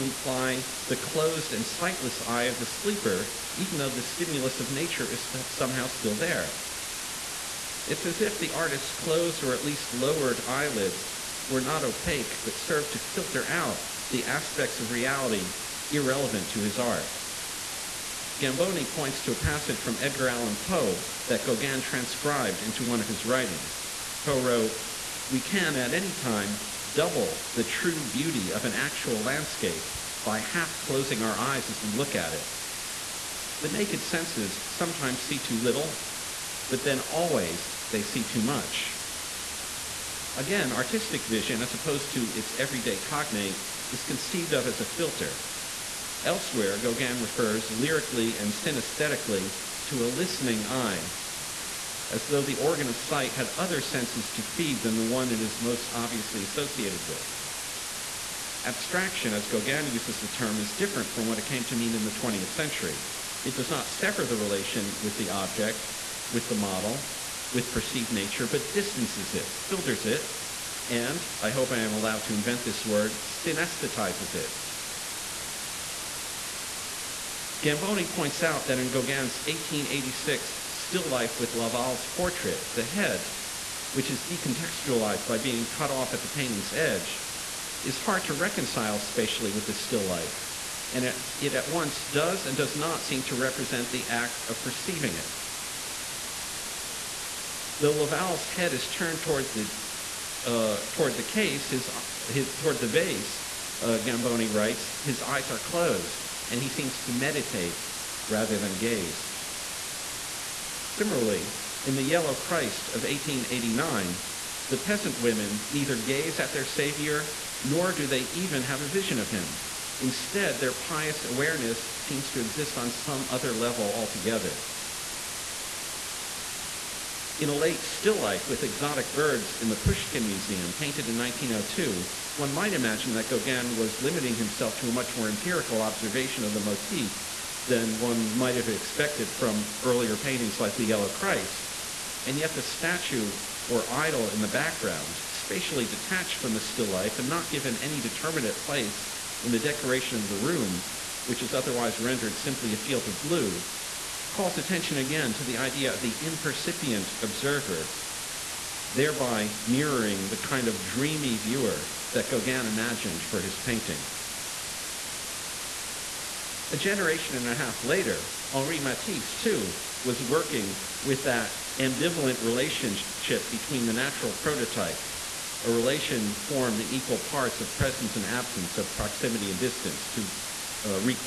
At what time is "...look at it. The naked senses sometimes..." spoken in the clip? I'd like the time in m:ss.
0:31.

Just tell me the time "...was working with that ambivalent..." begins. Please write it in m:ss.
2:50.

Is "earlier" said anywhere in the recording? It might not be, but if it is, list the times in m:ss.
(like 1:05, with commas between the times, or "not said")
2:19.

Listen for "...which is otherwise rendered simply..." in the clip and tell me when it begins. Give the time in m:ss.
2:31.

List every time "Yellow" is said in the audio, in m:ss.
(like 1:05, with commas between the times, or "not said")
1:52, 2:20.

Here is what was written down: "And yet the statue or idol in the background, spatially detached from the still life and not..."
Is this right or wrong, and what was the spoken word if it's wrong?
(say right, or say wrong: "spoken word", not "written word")
right.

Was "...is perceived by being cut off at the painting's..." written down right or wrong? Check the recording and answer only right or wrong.
wrong.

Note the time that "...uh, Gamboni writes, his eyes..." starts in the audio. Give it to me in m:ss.
1:43.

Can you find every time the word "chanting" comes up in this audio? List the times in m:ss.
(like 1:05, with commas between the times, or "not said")
not said.